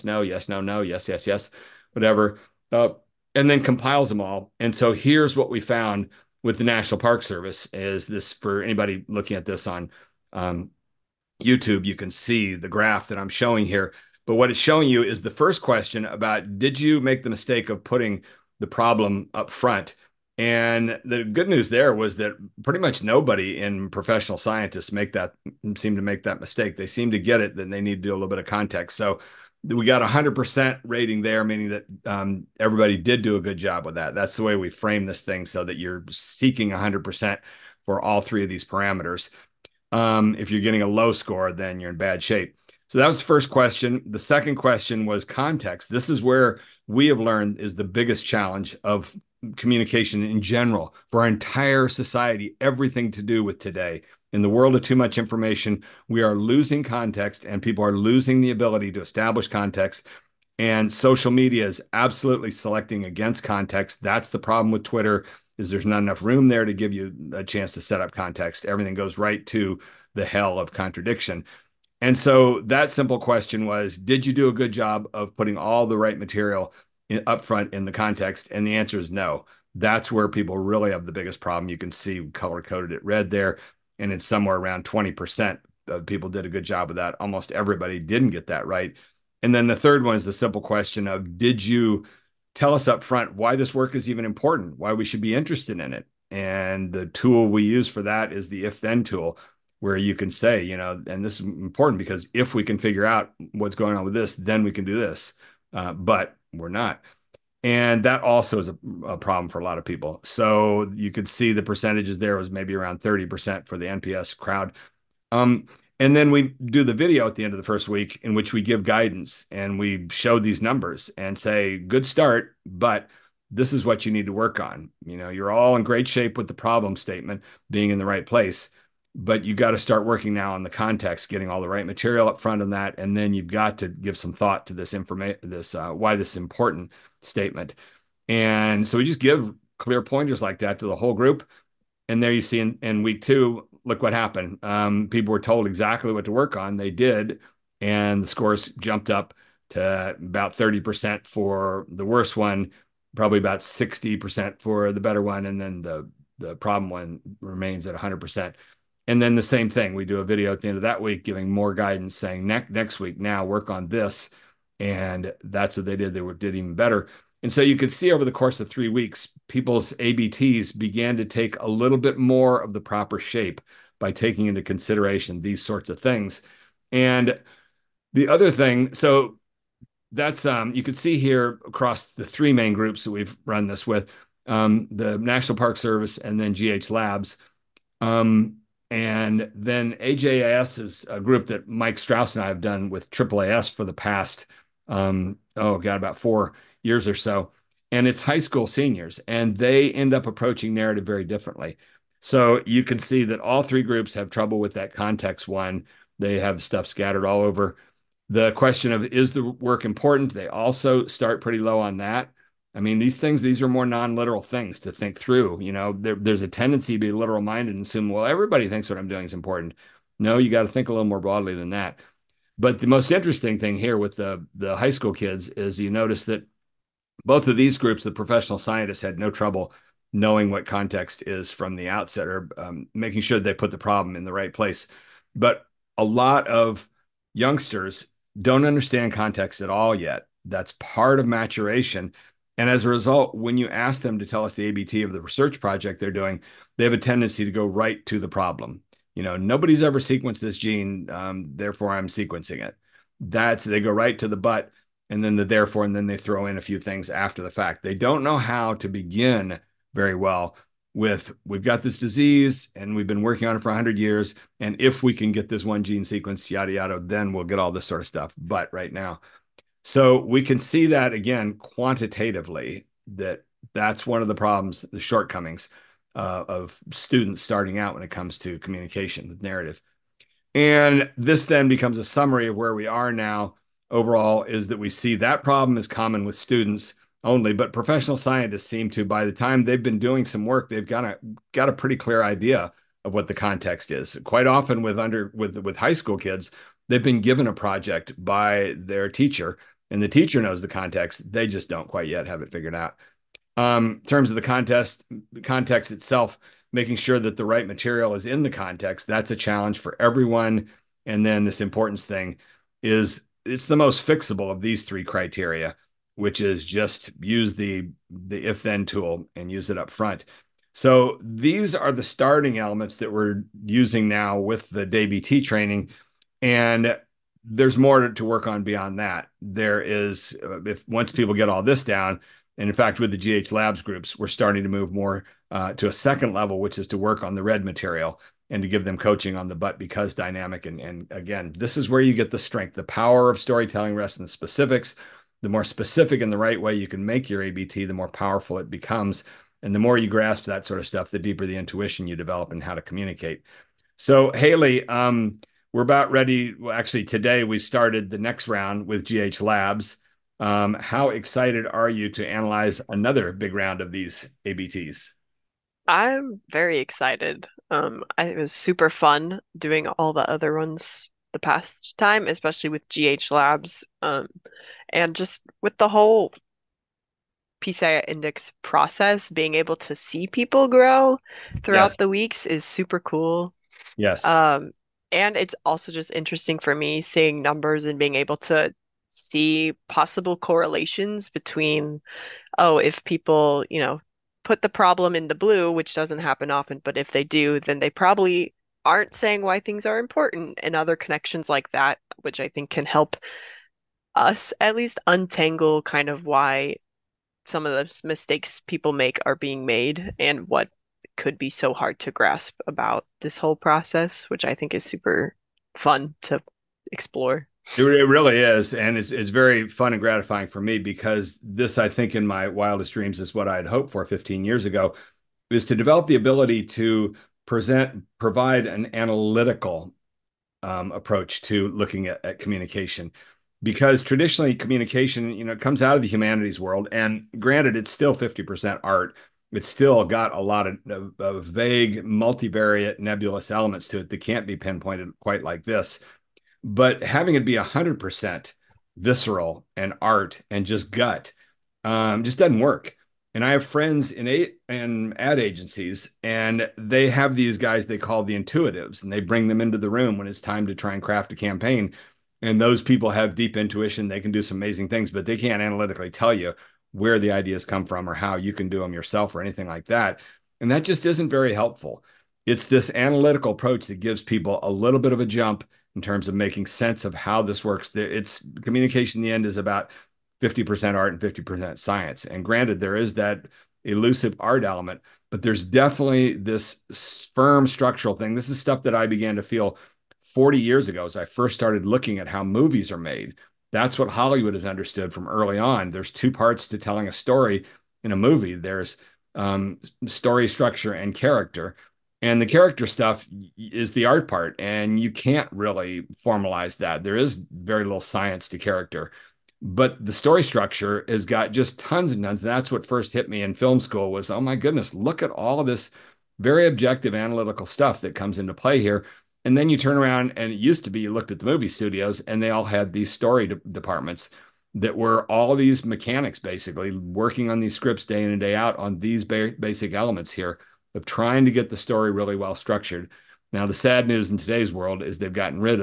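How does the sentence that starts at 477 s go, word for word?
It's communication in the end is about 50% art and 50% science.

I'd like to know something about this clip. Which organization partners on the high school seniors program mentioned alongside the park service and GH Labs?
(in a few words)
AAAS.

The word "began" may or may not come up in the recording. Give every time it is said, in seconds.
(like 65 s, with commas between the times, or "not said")
170 s, 489 s.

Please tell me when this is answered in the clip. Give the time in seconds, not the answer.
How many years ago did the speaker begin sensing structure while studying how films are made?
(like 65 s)
490 s.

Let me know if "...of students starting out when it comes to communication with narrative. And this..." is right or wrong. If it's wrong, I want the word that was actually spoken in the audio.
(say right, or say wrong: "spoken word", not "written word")
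right.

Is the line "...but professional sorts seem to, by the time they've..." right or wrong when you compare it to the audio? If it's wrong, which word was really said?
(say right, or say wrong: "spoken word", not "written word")
wrong: "scientists", not "sorts".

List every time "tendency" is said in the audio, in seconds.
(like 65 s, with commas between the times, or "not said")
216 s, 246 s.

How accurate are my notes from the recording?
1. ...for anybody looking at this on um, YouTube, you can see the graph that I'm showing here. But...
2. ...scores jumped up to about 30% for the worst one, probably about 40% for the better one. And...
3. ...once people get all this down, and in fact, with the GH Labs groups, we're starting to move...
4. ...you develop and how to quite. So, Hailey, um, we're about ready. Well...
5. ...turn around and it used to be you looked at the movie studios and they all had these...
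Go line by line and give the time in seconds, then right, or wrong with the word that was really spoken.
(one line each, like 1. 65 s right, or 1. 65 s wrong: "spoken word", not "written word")
1. 8 s right
2. 148 s wrong: "60", not "40"
3. 330 s right
4. 352 s wrong: "communicate", not "quite"
5. 519 s right.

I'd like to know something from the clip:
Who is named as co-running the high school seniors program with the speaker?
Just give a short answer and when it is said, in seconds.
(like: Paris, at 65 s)
Mike Strauss, at 191 s.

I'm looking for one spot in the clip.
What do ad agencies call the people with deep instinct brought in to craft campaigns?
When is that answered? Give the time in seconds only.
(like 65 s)
458 s.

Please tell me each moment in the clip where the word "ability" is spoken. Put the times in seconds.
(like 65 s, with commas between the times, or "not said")
58 s, 426 s.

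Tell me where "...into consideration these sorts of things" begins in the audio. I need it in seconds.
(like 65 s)
174 s.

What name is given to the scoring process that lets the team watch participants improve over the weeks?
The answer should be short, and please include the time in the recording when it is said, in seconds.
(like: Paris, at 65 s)
PCI index, at 377 s.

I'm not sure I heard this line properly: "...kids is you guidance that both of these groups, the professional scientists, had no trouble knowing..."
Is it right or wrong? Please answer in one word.
wrong.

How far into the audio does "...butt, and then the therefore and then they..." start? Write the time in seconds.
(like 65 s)
254 s.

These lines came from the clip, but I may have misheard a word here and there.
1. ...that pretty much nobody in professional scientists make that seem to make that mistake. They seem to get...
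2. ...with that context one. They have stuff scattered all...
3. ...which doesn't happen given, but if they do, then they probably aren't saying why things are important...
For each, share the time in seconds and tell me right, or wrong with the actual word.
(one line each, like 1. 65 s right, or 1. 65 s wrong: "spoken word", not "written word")
1. 22 s right
2. 204 s right
3. 395 s wrong: "often", not "given".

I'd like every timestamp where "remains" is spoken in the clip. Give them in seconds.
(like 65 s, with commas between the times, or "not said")
157 s.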